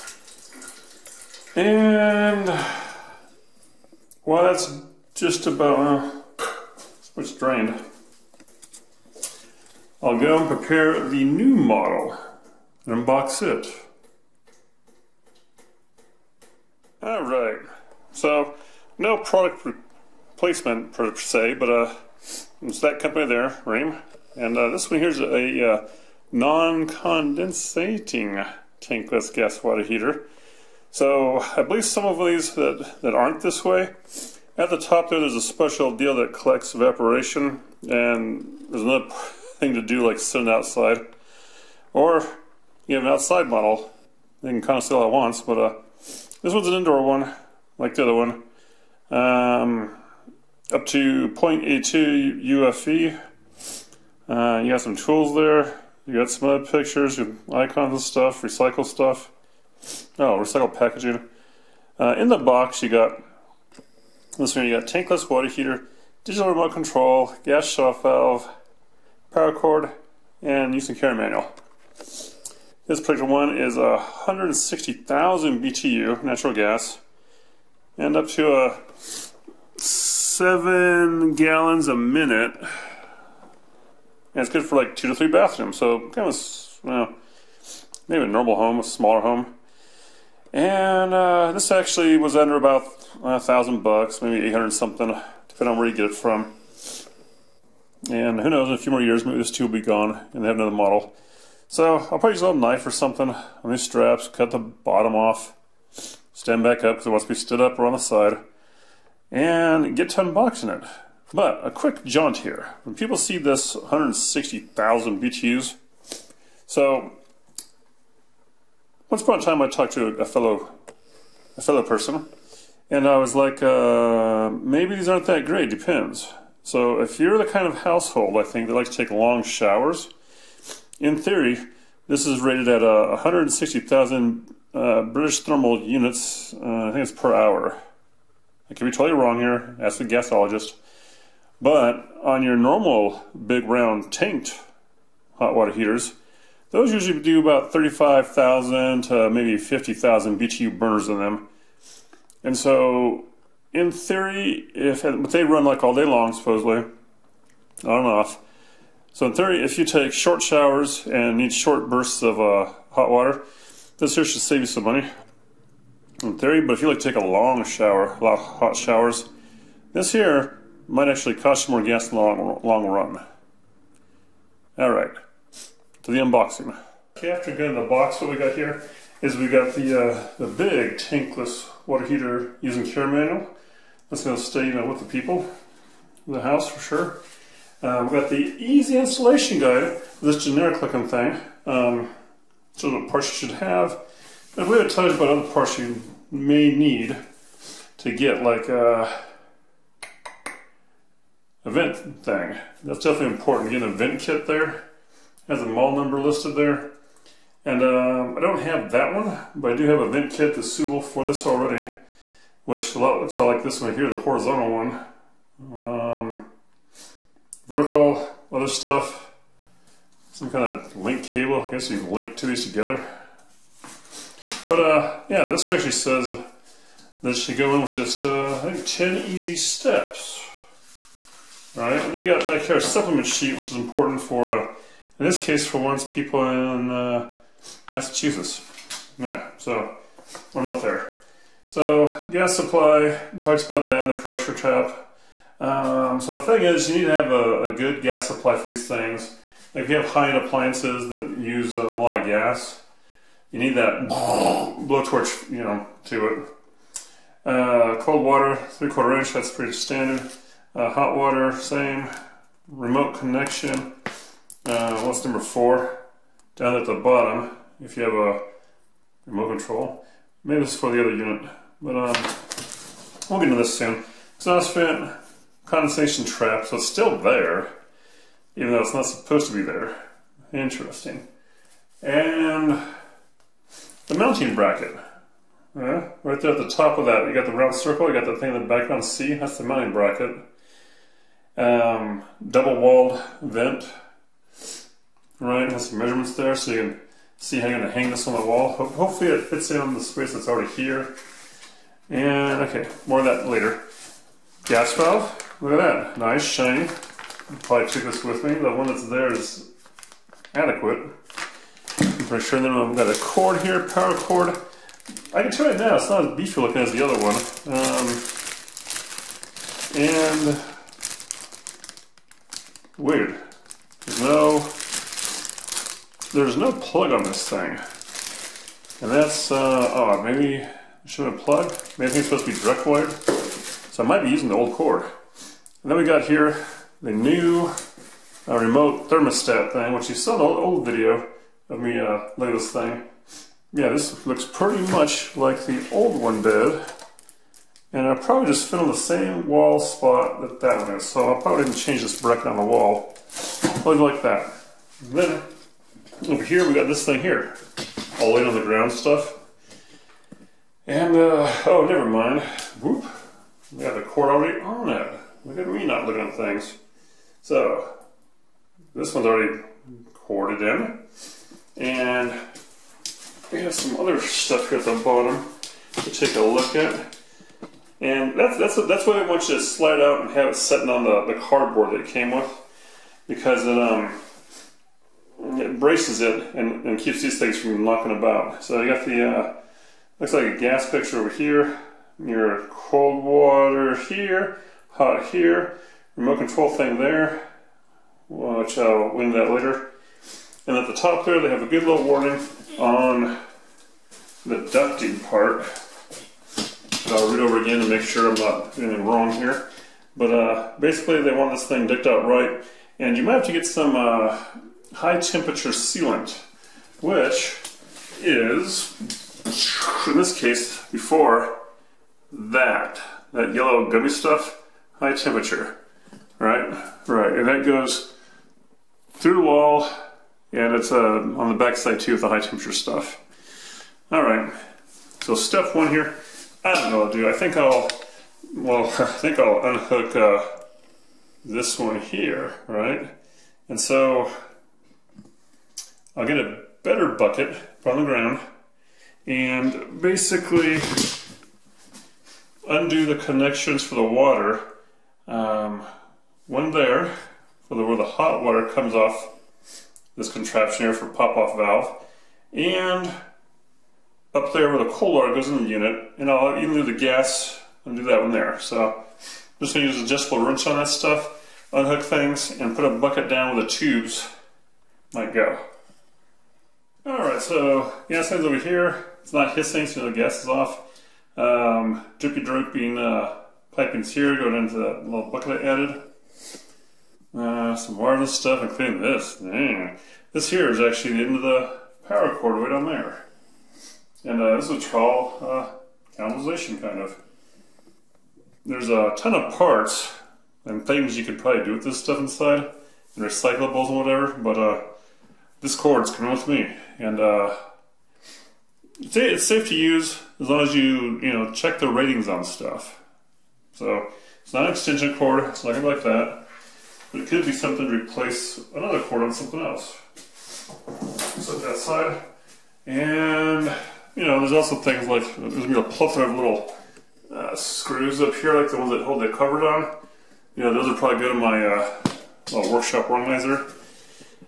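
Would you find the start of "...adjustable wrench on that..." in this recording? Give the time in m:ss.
7:50.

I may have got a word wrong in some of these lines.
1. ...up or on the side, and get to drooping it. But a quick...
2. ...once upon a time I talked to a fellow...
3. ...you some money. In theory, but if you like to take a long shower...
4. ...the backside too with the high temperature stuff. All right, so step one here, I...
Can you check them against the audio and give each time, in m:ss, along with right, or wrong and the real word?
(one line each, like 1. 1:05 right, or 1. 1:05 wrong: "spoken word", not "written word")
1. 1:47 wrong: "unboxing", not "drooping"
2. 1:59 right
3. 2:44 right
4. 7:11 right.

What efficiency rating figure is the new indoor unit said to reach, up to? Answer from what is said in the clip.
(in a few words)
0.82 UFE.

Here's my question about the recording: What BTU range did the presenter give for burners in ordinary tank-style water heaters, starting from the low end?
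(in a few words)
35,000 to 50,000.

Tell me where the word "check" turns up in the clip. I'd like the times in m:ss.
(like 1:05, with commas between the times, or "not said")
8:31.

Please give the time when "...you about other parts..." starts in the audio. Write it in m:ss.
3:15.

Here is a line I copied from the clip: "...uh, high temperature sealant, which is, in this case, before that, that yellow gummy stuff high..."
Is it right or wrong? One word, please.
right.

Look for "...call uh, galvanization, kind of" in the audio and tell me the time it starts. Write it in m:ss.
8:14.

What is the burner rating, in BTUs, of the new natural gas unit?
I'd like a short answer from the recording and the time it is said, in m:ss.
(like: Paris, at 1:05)
160,000, at 1:13.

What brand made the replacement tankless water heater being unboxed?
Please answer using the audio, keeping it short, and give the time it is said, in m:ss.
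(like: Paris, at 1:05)
Rheem, at 0:23.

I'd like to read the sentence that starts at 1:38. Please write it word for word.
And who knows, in a few more years, maybe this too will be gone and they have another model.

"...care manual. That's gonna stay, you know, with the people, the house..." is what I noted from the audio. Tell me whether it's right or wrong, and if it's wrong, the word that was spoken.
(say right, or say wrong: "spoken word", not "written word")
right.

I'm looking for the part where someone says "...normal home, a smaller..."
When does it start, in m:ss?
1:28.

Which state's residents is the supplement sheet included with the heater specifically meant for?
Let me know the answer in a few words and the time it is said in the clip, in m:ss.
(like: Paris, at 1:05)
Massachusetts, at 3:57.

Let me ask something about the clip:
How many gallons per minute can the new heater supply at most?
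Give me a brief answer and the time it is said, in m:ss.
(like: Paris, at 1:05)
7, at 1:19.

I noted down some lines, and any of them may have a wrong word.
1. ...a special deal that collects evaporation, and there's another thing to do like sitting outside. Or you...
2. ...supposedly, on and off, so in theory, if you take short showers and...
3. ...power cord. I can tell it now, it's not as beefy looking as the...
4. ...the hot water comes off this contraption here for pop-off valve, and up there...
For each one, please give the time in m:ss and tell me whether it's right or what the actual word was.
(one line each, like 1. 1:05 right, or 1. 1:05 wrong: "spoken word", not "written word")
1. 0:35 right
2. 2:36 right
3. 5:13 right
4. 7:37 right.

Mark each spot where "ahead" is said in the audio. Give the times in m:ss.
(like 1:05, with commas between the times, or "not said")
not said.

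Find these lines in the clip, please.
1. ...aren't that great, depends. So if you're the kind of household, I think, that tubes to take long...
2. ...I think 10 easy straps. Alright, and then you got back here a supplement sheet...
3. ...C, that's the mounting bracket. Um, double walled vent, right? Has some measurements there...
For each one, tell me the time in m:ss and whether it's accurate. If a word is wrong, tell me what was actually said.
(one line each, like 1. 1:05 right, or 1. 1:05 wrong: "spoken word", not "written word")
1. 2:05 wrong: "likes", not "tubes"
2. 3:48 wrong: "steps", not "straps"
3. 4:49 right.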